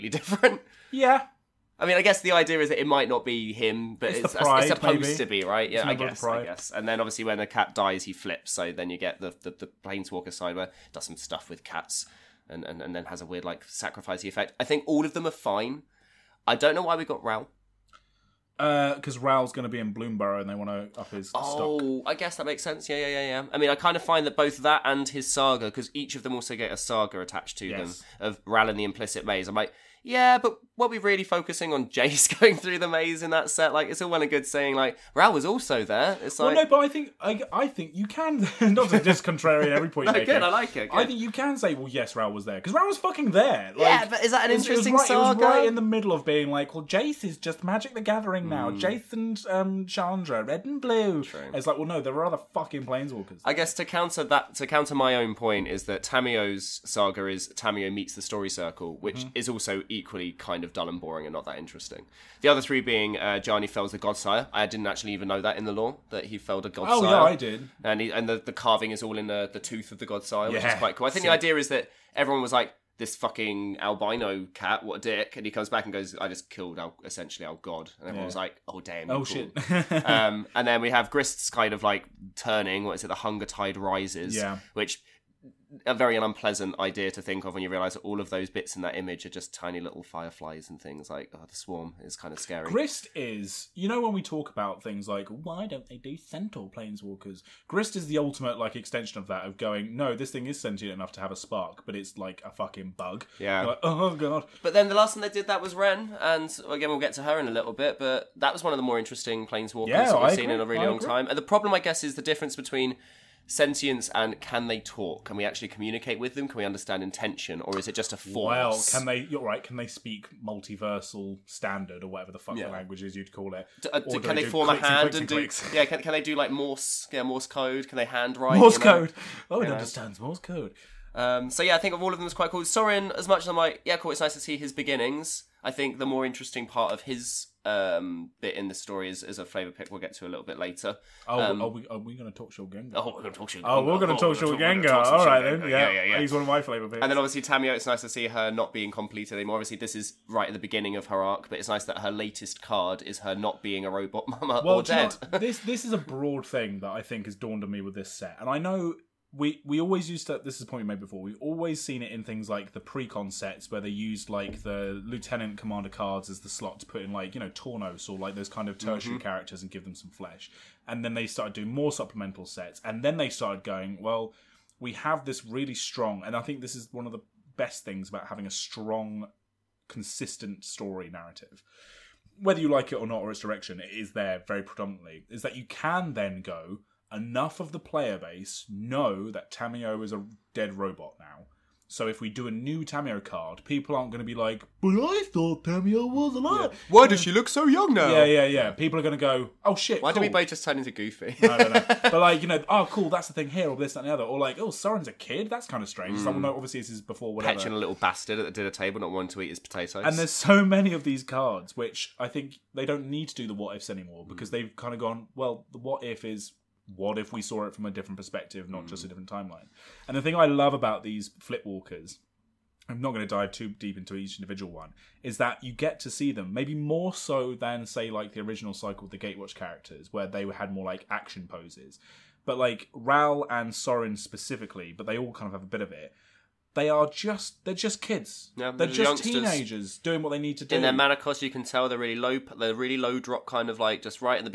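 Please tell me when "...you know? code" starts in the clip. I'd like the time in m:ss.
2:08.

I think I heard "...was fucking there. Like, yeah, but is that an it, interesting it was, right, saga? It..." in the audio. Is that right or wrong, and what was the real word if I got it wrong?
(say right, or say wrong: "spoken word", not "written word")
right.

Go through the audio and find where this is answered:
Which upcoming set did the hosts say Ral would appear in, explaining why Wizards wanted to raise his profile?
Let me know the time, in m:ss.
0:19.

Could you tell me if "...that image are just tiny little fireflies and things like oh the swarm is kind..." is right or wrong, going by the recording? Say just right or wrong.
right.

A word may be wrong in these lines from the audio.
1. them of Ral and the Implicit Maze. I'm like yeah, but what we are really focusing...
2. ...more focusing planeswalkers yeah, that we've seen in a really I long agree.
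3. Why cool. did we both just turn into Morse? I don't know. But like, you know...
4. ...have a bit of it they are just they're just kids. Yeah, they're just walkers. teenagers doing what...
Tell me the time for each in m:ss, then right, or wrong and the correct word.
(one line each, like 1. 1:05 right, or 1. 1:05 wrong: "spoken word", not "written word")
1. 0:28 right
2. 1:48 wrong: "interesting", not "focusing"
3. 3:20 wrong: "Goofy", not "Morse"
4. 3:55 wrong: "youngsters", not "walkers".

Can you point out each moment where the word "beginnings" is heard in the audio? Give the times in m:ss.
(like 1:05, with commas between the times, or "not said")
2:14, 2:30.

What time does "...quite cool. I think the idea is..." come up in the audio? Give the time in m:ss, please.
1:10.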